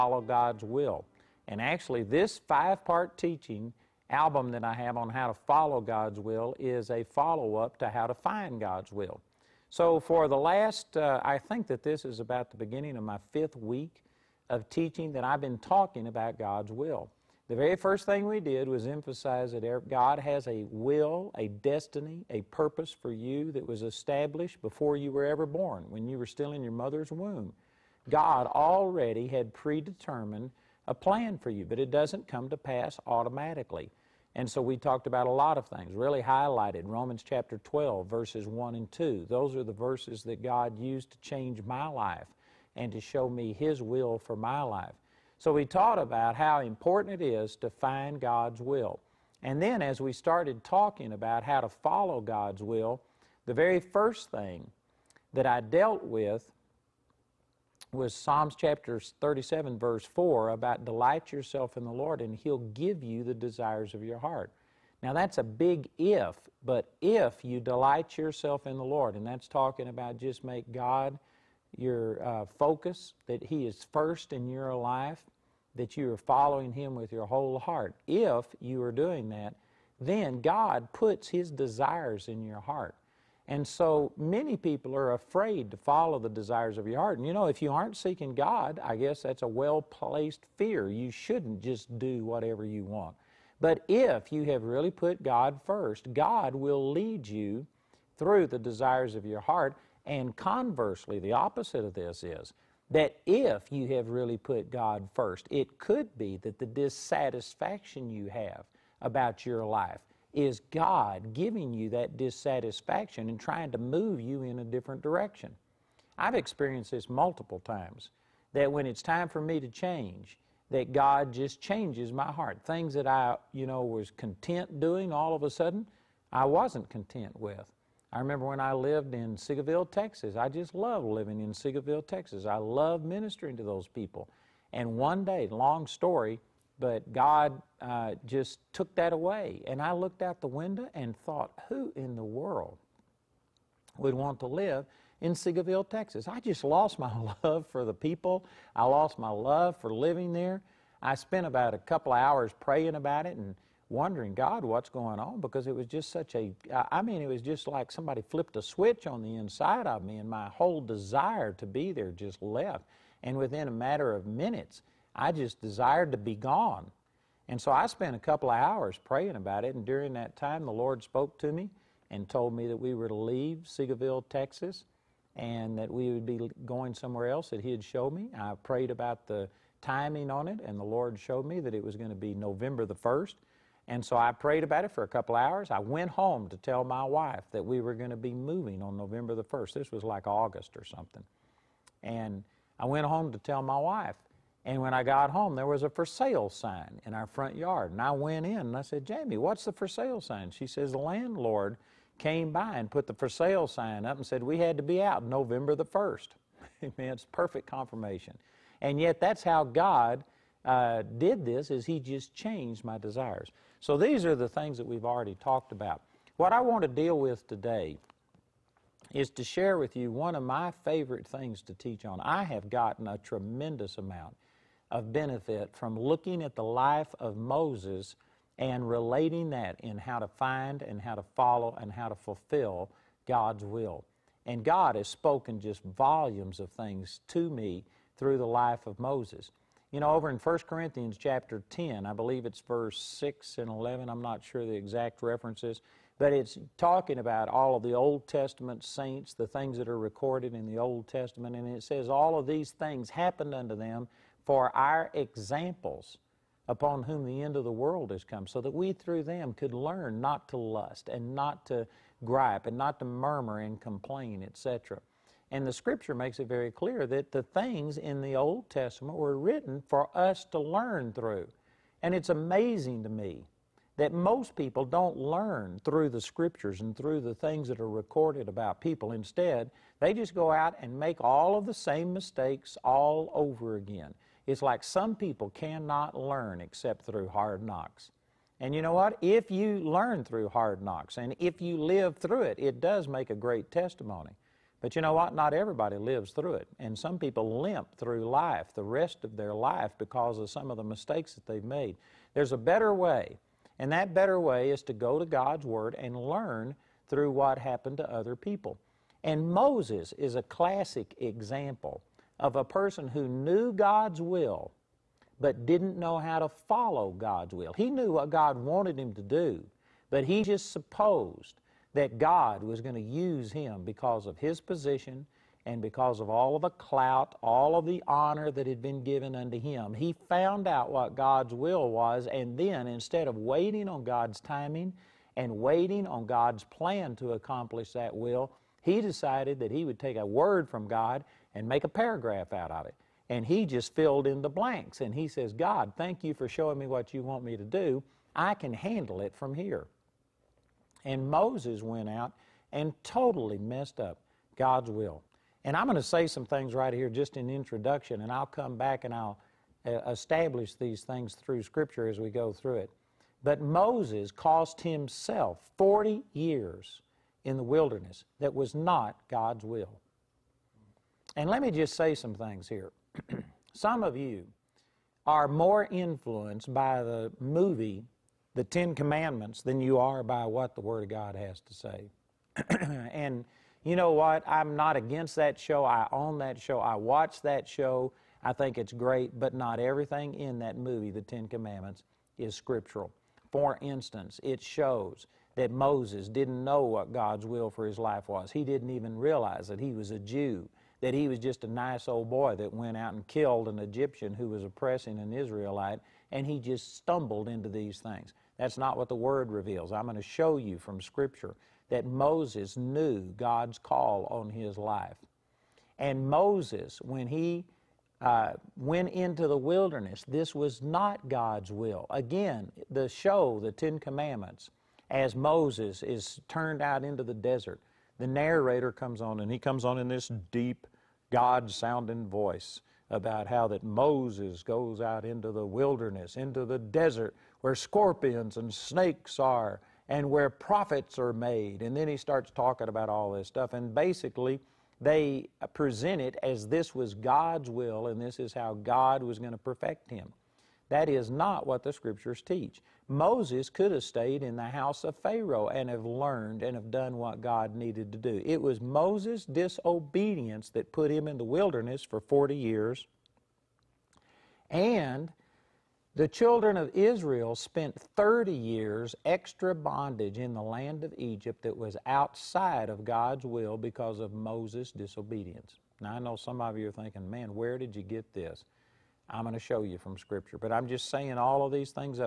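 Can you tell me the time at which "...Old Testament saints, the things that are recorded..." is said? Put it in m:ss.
4:07.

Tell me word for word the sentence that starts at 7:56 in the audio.
Now, I know some of you are thinking, man, where did you get this?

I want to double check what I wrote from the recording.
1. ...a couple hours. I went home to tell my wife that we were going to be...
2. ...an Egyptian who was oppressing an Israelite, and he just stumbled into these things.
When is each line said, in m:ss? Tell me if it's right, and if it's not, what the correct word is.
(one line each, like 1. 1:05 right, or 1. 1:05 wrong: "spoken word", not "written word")
1. 3:05 right
2. 6:43 right.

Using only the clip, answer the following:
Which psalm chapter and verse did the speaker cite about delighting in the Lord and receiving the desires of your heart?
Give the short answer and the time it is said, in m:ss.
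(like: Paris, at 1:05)
Psalms 37:4, at 0:58.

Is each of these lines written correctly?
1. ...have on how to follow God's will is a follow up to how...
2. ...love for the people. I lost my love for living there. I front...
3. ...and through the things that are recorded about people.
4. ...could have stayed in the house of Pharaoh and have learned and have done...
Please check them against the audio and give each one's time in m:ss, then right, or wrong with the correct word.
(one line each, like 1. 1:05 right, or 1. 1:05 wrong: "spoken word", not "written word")
1. 0:04 right
2. 2:27 wrong: "spent", not "front"
3. 4:36 right
4. 7:33 right.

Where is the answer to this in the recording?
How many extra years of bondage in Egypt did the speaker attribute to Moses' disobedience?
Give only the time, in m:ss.
7:47.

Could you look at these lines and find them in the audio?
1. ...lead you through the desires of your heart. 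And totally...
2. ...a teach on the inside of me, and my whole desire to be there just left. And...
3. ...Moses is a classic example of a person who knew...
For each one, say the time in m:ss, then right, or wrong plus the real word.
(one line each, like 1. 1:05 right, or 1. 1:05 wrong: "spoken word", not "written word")
1. 1:36 wrong: "conversely", not "totally"
2. 2:38 wrong: "switch", not "teach"
3. 5:09 right.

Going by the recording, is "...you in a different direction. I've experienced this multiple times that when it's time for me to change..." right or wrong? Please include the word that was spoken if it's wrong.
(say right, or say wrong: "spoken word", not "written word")
right.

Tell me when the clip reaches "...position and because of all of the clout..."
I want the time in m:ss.
5:24.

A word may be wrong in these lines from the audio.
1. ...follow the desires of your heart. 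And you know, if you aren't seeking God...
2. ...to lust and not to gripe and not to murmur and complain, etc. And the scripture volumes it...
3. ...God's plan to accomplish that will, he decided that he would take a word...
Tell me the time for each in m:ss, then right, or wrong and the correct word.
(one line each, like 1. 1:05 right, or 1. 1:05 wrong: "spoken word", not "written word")
1. 1:25 right
2. 4:20 wrong: "makes", not "volumes"
3. 5:36 right.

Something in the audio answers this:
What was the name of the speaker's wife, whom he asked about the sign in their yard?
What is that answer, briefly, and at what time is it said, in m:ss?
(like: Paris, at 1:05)
Jamie, at 3:19.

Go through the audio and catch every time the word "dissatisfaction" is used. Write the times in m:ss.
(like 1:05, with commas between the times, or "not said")
1:46, 1:52.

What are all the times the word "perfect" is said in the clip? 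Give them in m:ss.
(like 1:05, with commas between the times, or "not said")
3:27, 7:29.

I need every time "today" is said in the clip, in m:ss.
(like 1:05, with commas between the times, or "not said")
3:37.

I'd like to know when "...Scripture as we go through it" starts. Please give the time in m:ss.
6:01.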